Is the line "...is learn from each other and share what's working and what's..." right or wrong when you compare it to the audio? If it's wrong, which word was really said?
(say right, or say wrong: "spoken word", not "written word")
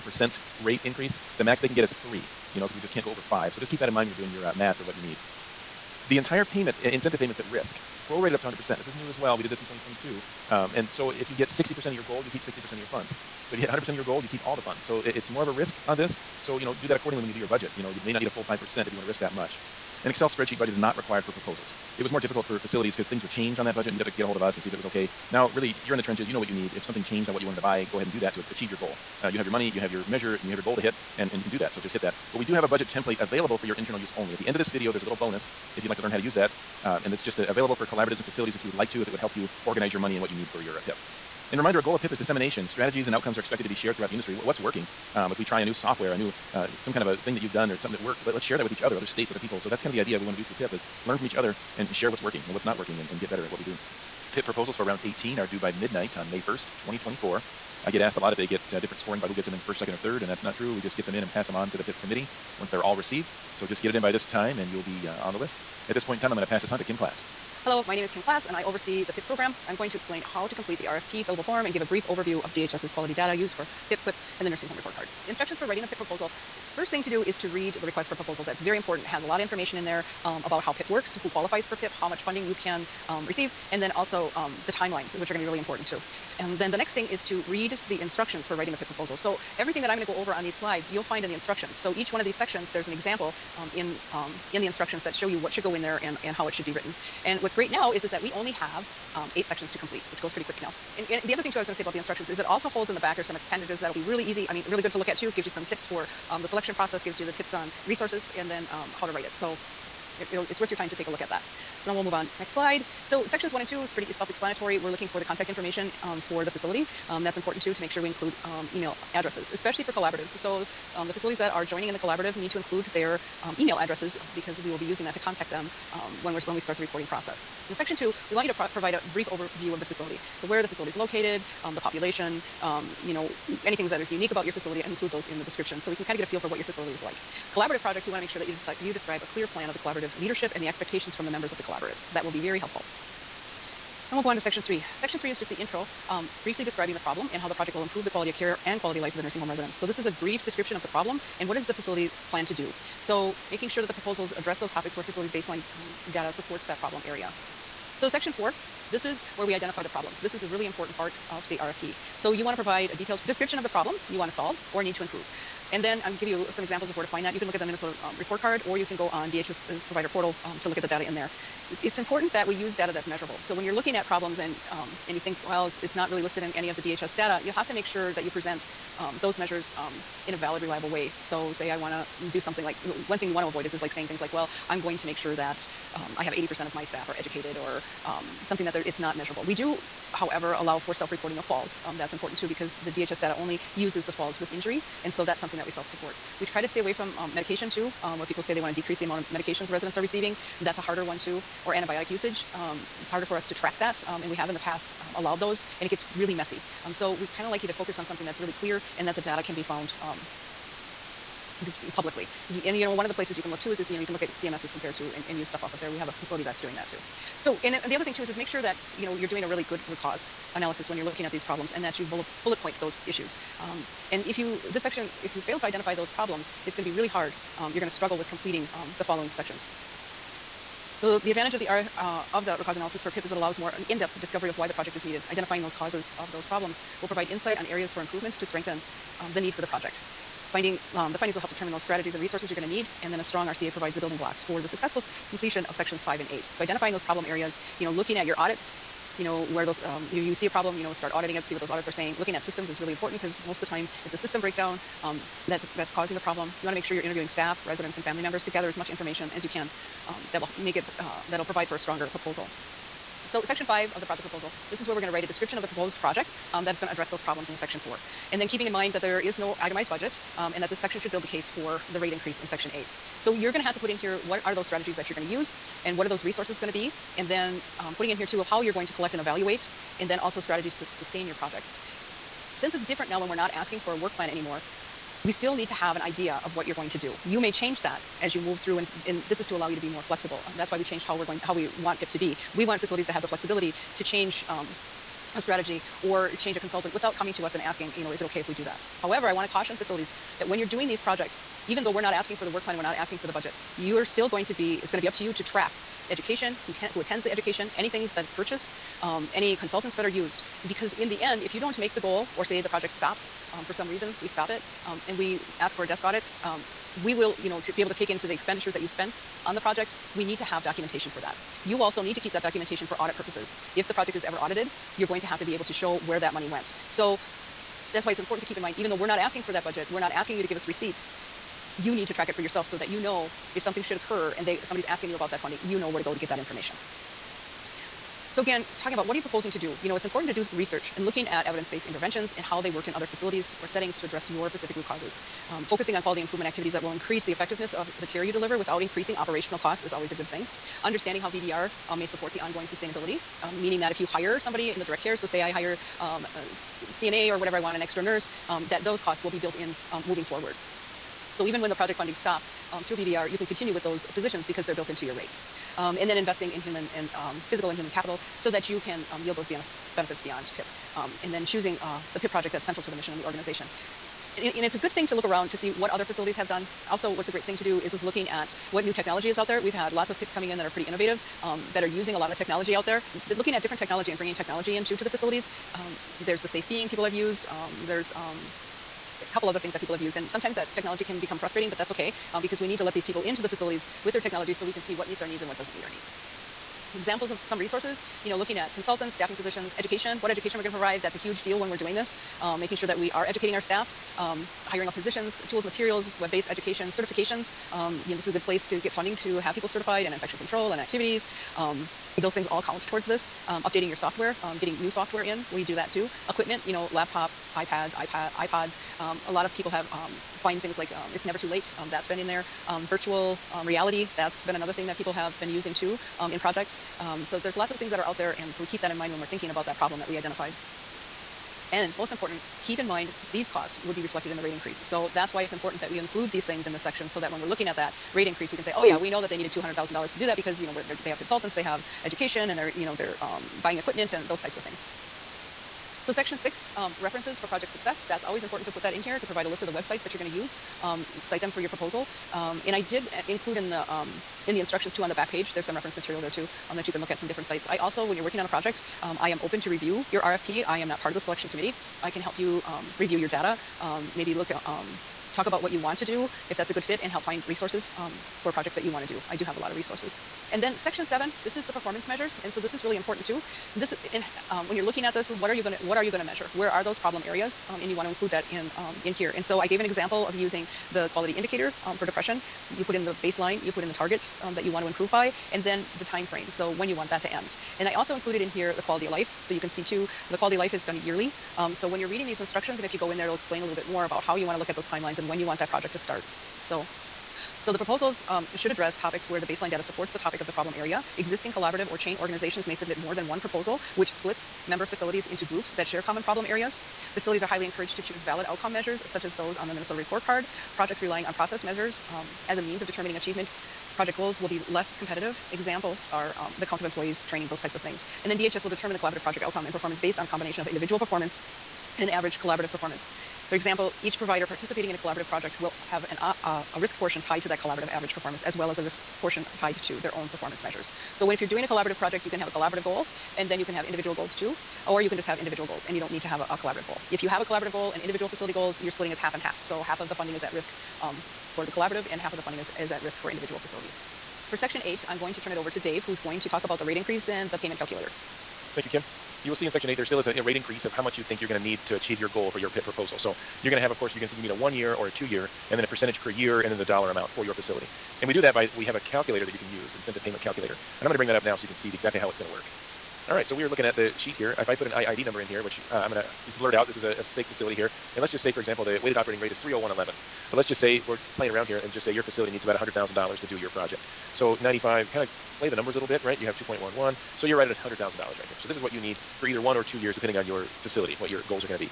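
right.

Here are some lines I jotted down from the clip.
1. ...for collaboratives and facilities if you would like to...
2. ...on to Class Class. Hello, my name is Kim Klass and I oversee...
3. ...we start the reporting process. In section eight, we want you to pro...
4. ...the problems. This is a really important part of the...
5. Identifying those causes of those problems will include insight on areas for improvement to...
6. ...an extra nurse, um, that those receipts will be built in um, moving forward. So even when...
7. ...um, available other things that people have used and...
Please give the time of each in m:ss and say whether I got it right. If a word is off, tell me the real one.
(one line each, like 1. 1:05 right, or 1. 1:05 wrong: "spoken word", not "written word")
1. 0:37 right
2. 1:06 wrong: "Kim", not "Class"
3. 2:06 wrong: "two", not "eight"
4. 2:39 right
5. 3:55 wrong: "provide", not "include"
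6. 5:57 wrong: "costs", not "receipts"
7. 6:28 wrong: "couple", not "available".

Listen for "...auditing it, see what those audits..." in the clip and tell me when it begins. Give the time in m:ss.
4:11.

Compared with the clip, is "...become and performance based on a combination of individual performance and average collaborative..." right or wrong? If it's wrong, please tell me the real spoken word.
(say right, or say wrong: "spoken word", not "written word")
wrong: "outcome", not "become".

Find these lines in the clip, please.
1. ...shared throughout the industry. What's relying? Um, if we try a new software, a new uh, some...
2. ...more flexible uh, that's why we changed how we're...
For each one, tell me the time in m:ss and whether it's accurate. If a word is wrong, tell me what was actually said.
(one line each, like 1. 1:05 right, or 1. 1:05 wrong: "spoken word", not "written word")
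1. 0:43 wrong: "working", not "relying"
2. 4:49 right.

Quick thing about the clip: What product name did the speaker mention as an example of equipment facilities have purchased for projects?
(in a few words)
It's Never 2 Late.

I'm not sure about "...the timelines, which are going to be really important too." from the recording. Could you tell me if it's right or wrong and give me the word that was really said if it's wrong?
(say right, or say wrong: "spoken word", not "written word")
right.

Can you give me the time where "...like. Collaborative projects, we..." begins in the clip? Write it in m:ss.
2:17.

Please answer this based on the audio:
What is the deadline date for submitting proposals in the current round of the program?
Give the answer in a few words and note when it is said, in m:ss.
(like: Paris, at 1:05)
May 1st, 2024, at 0:56.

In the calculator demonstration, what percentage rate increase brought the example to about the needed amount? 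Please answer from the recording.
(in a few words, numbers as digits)
2.11.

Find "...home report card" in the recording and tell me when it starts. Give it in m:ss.
1:14.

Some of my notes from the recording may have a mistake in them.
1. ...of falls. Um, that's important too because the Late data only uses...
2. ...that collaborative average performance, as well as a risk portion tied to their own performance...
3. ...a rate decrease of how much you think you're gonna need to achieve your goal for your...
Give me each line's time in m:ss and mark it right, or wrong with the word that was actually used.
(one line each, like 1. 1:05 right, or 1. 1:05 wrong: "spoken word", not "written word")
1. 3:11 wrong: "DHS", not "Late"
2. 8:47 right
3. 9:10 wrong: "increase", not "decrease".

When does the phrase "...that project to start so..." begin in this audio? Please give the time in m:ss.
8:15.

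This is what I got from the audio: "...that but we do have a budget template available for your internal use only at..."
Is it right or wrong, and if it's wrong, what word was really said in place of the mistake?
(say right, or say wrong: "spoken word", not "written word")
right.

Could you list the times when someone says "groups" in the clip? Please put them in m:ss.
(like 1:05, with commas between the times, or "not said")
8:25.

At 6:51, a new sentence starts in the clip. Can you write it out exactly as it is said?
Um, those things all count towards this.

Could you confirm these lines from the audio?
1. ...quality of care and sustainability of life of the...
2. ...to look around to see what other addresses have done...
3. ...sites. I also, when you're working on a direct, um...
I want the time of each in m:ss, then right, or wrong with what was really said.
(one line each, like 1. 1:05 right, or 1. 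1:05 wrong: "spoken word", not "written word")
1. 2:28 wrong: "quality", not "sustainability"
2. 6:15 wrong: "facilities", not "addresses"
3. 7:37 wrong: "project", not "direct".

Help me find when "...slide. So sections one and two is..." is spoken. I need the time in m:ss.
1:52.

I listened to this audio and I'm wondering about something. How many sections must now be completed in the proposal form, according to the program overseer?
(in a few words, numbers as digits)
8.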